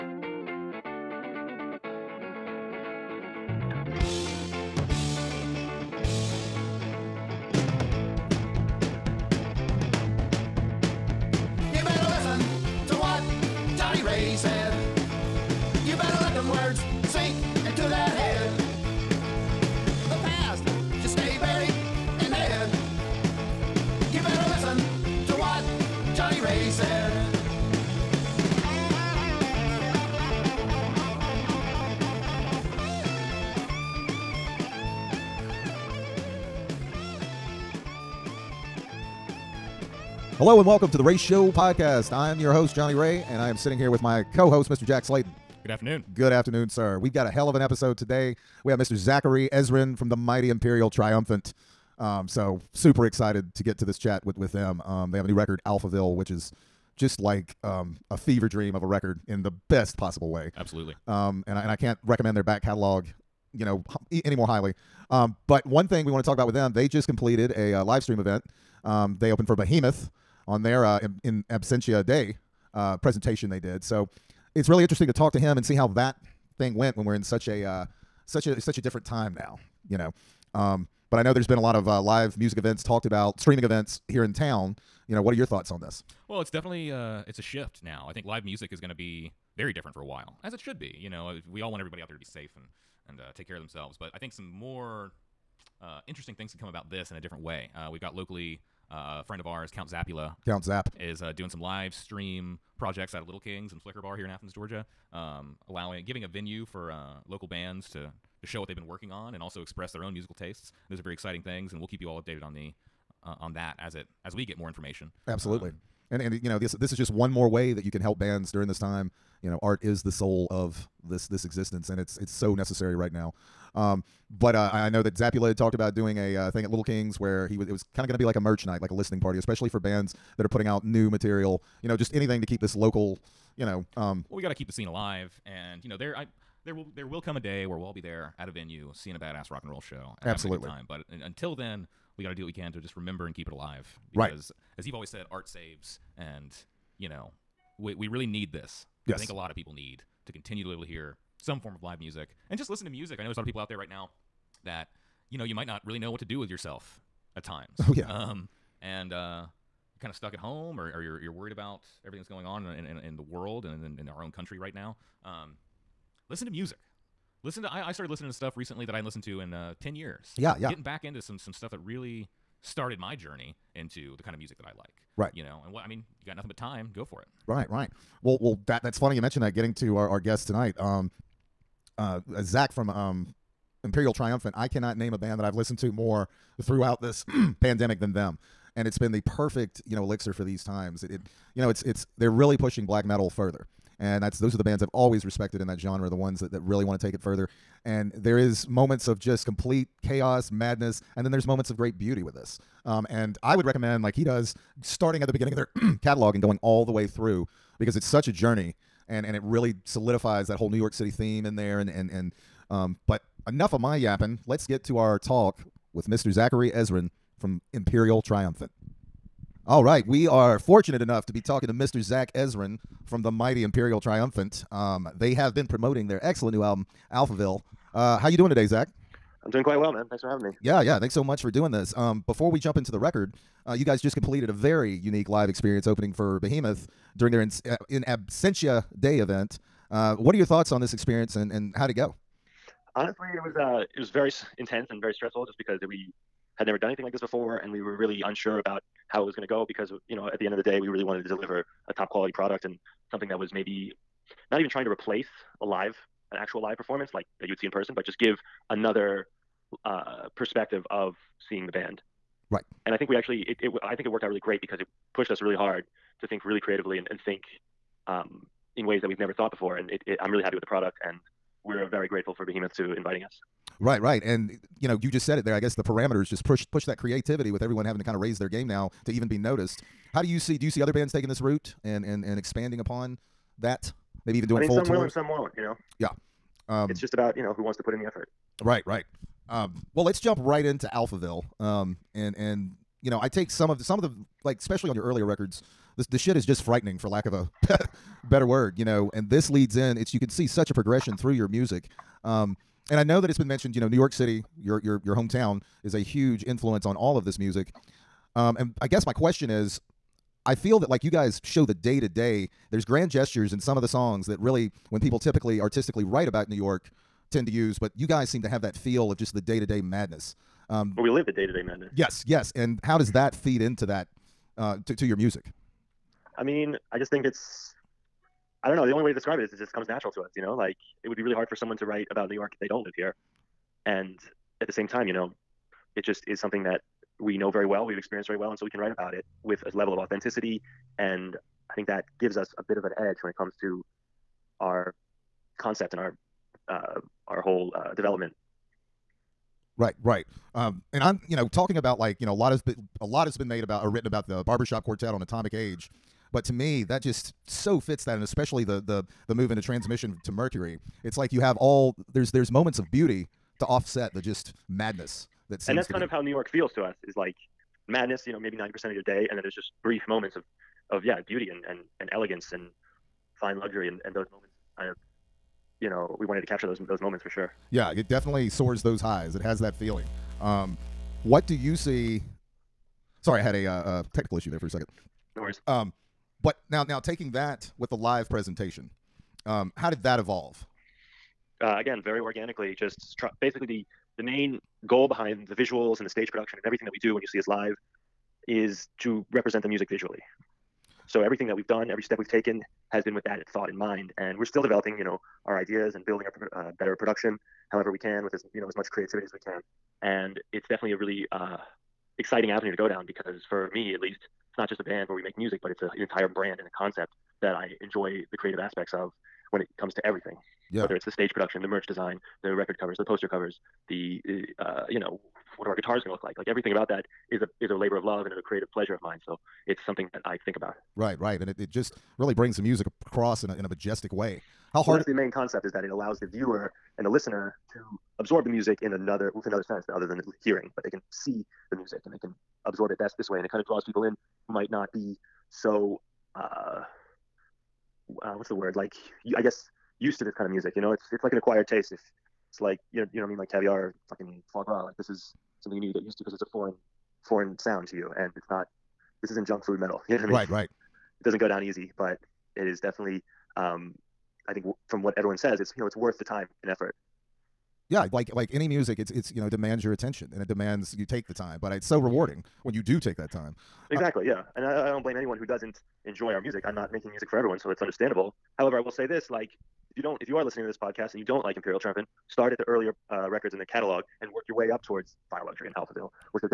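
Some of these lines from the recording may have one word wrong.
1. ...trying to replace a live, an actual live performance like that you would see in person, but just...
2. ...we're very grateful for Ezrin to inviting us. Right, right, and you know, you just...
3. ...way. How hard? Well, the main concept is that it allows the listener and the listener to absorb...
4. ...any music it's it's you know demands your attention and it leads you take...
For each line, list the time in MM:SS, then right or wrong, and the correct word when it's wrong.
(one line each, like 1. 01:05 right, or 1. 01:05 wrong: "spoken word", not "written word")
1. 04:14 right
2. 04:31 wrong: "Behemoth", not "Ezrin"
3. 07:14 wrong: "viewer", not "listener"
4. 07:48 wrong: "demands", not "leads".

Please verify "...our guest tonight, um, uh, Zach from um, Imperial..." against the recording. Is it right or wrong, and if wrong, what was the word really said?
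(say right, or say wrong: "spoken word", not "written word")
right.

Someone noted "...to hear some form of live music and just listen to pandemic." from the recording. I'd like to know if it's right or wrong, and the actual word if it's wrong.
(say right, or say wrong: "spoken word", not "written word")
wrong: "music", not "pandemic".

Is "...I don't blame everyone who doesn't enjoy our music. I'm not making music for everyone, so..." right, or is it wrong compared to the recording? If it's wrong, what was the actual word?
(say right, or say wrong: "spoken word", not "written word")
wrong: "anyone", not "everyone".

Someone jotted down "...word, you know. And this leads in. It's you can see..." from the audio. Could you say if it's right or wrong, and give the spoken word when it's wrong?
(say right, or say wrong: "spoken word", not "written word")
right.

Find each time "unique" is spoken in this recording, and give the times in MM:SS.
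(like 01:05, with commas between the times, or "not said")
03:54.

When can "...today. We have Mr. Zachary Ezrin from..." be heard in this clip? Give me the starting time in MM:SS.
00:47.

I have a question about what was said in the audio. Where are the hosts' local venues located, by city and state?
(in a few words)
Athens, Georgia.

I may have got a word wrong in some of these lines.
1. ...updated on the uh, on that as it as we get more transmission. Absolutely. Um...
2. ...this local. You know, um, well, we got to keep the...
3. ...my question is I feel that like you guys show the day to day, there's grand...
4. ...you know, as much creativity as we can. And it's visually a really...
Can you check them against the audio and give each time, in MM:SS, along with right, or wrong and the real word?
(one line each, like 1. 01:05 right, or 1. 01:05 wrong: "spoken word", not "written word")
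1. 01:52 wrong: "information", not "transmission"
2. 02:12 right
3. 05:09 right
4. 06:48 wrong: "definitely", not "visually".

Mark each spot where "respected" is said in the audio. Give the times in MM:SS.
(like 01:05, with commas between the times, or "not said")
03:15.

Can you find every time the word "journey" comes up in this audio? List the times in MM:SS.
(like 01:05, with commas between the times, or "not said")
02:53, 03:28.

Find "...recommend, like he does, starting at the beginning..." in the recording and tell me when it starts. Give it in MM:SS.
03:23.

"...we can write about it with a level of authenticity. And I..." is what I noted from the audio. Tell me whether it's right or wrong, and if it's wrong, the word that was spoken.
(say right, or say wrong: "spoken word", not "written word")
right.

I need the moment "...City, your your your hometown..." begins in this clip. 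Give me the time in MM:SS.
05:04.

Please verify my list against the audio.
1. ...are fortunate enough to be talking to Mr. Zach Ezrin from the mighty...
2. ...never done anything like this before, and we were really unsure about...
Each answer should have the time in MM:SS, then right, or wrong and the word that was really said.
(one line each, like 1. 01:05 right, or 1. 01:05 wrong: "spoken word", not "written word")
1. 03:40 right
2. 04:06 right.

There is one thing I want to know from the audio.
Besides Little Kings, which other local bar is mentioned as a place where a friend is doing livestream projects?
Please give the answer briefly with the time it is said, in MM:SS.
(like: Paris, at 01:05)
Flicker Bar, at 01:43.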